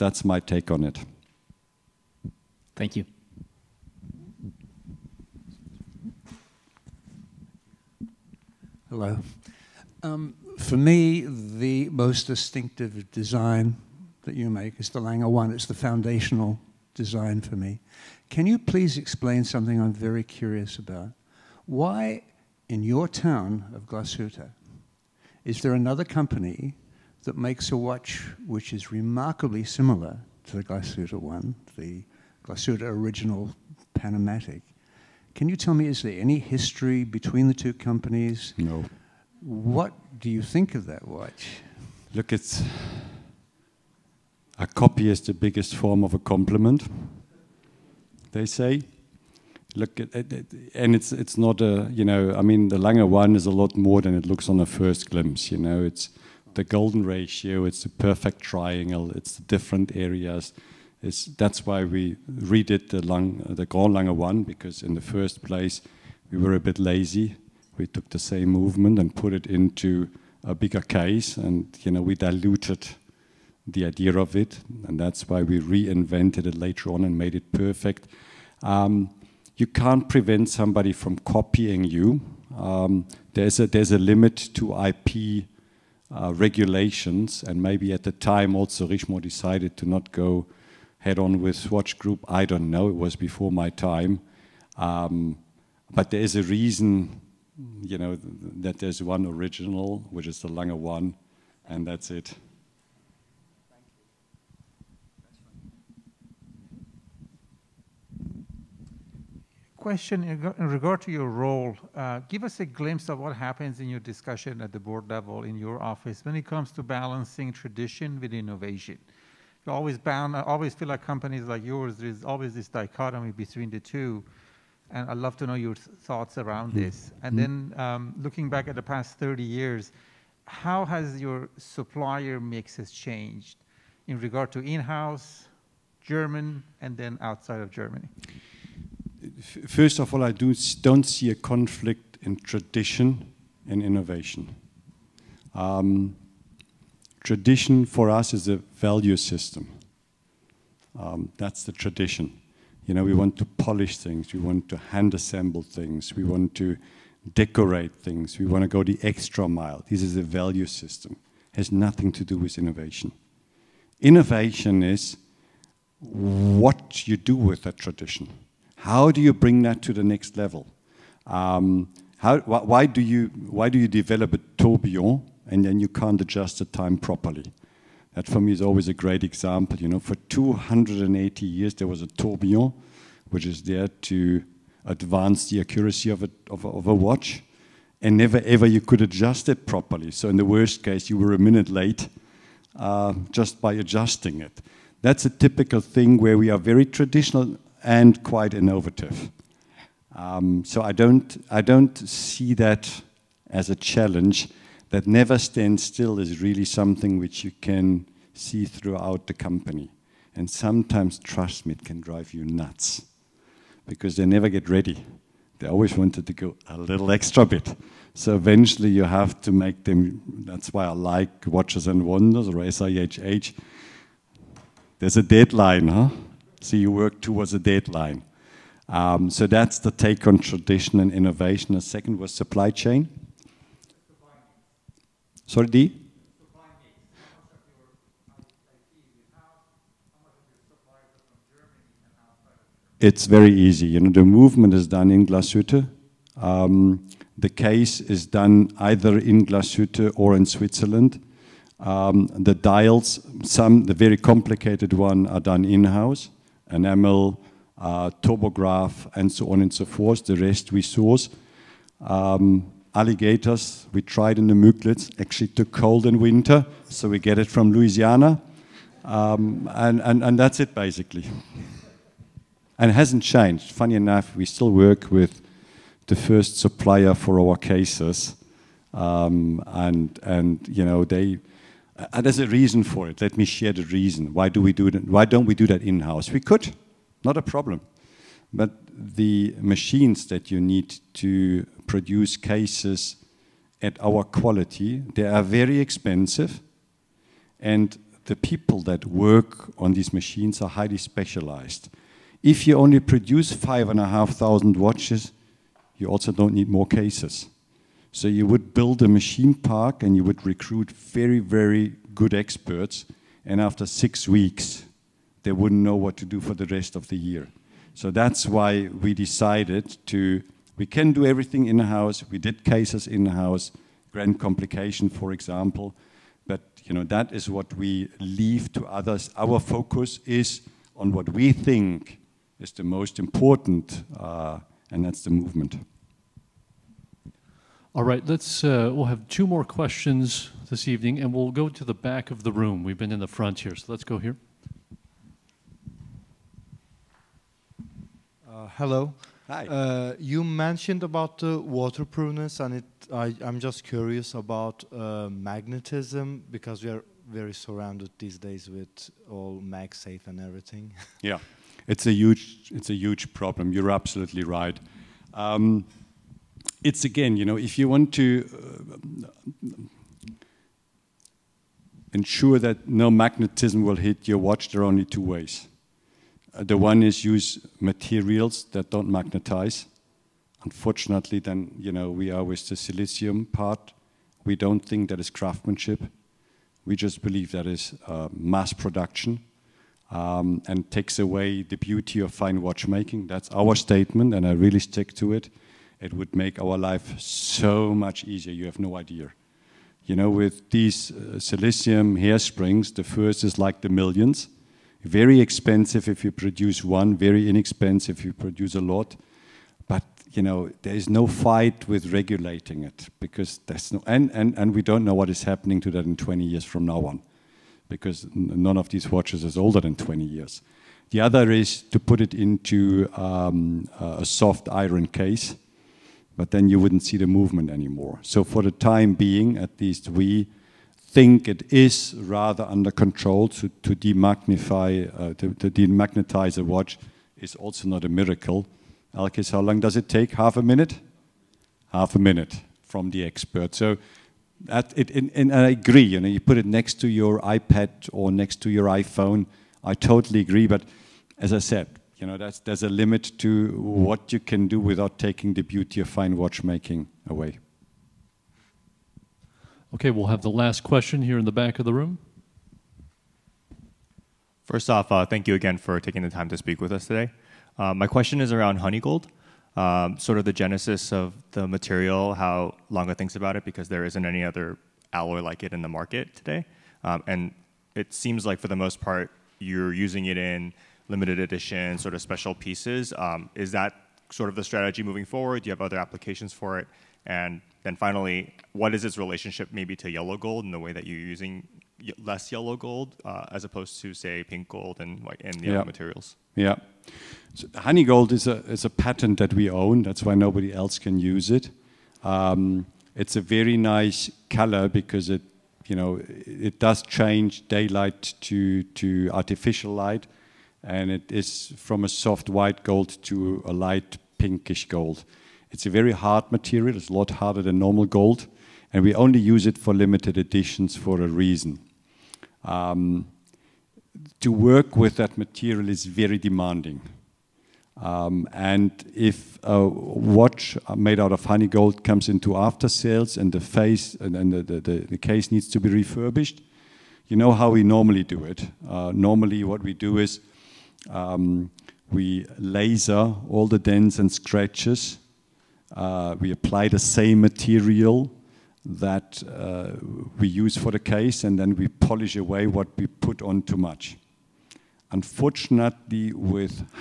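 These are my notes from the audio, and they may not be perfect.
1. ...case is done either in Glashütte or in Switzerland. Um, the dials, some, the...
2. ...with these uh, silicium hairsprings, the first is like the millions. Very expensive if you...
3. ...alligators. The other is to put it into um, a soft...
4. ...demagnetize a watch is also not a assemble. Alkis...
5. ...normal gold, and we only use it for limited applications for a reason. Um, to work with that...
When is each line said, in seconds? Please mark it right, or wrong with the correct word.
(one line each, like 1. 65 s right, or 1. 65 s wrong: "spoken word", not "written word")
1. 247 s right
2. 400 s right
3. 420 s wrong: "years", not "alligators"
4. 435 s wrong: "miracle", not "assemble"
5. 517 s wrong: "editions", not "applications".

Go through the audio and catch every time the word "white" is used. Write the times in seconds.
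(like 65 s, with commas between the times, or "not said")
495 s, 512 s.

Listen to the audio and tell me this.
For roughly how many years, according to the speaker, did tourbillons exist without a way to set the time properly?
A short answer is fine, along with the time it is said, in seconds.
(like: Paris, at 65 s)
280 years, at 180 s.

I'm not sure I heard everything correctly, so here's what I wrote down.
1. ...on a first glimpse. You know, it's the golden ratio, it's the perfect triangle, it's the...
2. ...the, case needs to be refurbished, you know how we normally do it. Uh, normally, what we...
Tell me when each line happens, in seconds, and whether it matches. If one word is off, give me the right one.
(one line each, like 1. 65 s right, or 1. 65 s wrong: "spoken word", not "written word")
1. 54 s right
2. 535 s right.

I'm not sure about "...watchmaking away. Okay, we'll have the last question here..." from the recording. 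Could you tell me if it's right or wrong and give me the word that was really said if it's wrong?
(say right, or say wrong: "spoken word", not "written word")
right.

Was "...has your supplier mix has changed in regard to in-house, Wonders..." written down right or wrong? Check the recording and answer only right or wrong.
wrong.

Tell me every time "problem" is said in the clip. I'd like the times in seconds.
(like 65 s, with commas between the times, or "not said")
287 s, 363 s.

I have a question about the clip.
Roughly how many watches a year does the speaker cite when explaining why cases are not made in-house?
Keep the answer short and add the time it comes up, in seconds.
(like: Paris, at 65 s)
5,500, at 303 s.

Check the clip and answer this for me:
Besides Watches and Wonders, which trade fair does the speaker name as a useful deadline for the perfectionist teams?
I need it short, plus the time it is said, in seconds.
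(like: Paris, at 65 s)
SIHH, at 222 s.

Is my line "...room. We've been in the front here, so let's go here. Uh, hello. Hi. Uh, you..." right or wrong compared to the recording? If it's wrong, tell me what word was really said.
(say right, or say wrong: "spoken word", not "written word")
right.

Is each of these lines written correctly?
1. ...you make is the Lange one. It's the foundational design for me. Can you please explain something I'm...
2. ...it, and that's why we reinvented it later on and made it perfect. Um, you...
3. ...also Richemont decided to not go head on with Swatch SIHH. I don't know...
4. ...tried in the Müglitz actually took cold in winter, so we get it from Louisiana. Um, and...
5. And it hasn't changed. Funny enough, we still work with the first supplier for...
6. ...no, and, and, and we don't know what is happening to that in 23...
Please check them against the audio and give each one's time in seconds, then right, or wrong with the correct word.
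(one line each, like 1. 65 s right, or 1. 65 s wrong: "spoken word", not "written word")
1. 14 s right
2. 74 s right
3. 88 s wrong: "Group", not "SIHH"
4. 264 s right
5. 272 s right
6. 413 s wrong: "20", not "23".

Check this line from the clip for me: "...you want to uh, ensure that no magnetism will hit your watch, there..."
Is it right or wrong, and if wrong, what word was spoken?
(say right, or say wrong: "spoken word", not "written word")
right.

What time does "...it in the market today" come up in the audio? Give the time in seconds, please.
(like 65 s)
475 s.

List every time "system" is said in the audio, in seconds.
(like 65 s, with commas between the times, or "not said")
149 s, 160 s.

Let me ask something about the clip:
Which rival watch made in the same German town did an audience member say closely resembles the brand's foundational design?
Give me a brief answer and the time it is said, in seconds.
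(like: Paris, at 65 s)
Glashütte Original PanoMatic, at 32 s.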